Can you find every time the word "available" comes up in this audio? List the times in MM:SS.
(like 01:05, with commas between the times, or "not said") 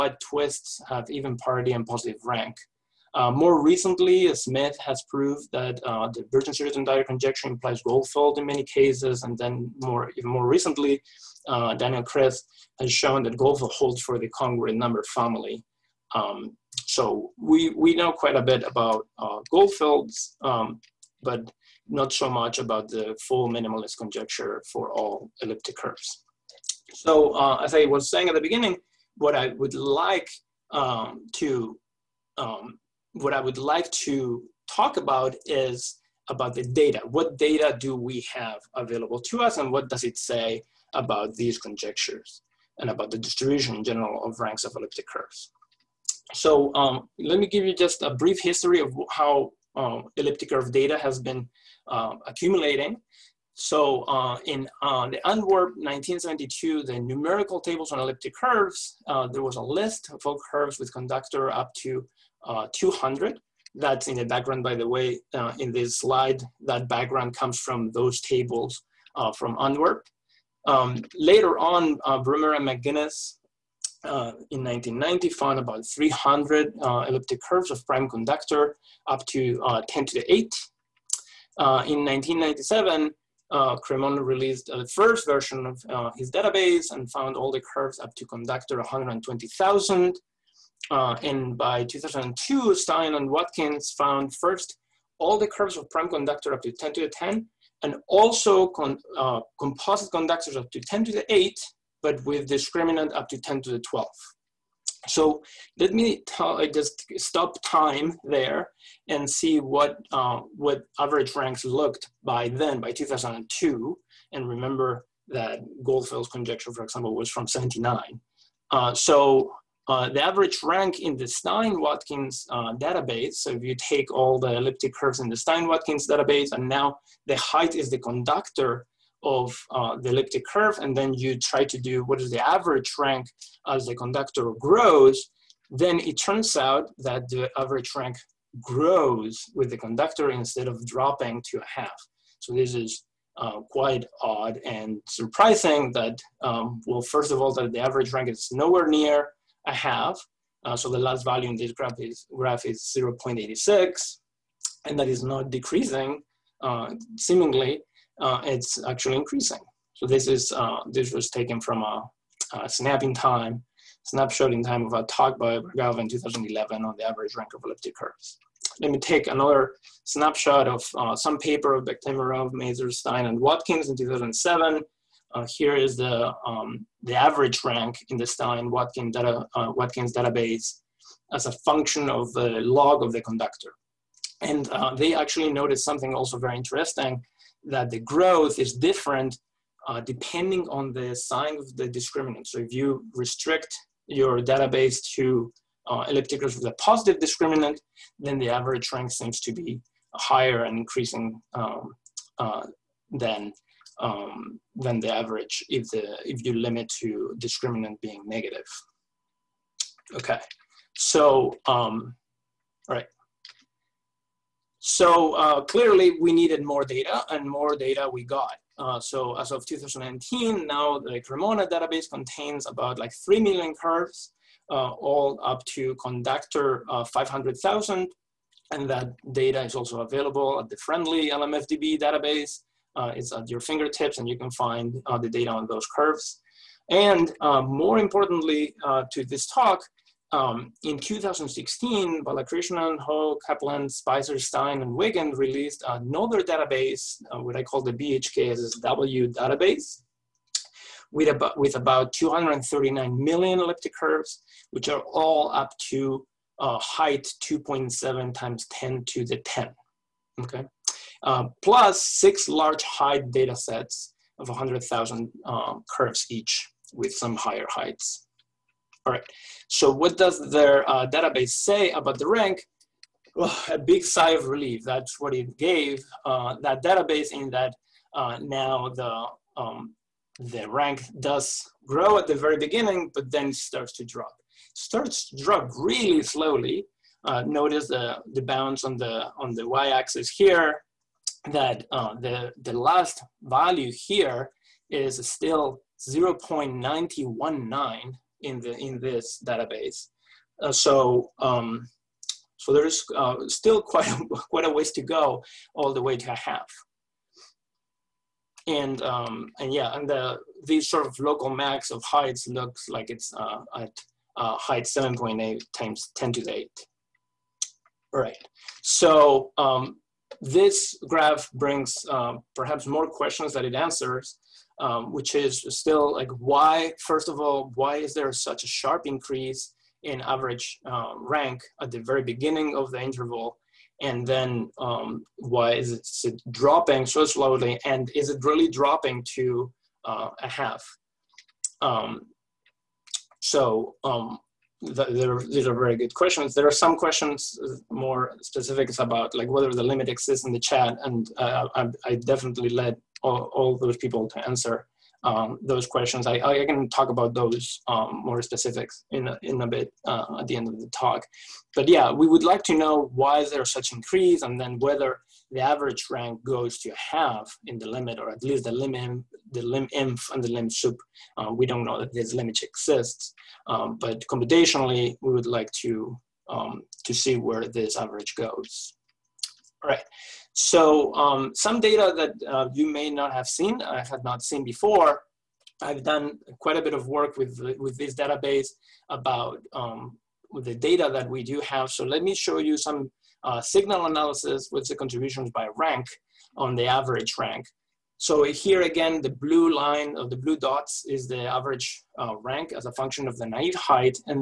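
00:38, 03:50.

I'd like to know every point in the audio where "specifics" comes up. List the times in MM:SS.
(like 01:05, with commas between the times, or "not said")
05:48, 05:58.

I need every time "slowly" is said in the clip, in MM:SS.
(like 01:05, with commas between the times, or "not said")
04:46, 05:37.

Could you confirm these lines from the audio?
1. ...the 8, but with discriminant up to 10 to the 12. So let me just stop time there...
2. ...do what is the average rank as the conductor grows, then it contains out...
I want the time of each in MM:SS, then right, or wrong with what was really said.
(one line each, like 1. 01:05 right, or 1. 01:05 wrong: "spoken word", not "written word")
1. 01:41 right
2. 02:11 wrong: "turns", not "contains".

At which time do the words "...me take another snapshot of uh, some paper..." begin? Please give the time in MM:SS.
02:48.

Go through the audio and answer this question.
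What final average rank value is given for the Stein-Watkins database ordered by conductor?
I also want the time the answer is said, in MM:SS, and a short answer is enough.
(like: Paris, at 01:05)
0.86, at 02:32.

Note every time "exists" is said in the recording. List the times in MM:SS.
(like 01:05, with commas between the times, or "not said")
05:50, 06:12.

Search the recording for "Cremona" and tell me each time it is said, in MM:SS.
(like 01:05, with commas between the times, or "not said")
01:23, 03:41.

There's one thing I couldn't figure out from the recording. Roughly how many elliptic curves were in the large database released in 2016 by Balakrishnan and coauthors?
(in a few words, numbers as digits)
239 million.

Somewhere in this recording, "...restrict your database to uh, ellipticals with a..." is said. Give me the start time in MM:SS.
03:13.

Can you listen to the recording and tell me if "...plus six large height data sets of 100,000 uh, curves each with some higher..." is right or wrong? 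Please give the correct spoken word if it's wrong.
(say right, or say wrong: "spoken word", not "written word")
right.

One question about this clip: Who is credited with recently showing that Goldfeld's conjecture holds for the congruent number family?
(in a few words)
Daniel Kriz.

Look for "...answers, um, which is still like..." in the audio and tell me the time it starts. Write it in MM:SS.
05:23.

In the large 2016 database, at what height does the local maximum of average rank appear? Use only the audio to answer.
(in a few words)
7.8 times 10 to the 8.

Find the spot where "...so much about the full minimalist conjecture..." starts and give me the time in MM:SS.
00:22.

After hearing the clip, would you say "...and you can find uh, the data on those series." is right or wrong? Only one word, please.
wrong.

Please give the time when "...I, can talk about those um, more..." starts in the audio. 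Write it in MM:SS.
05:56.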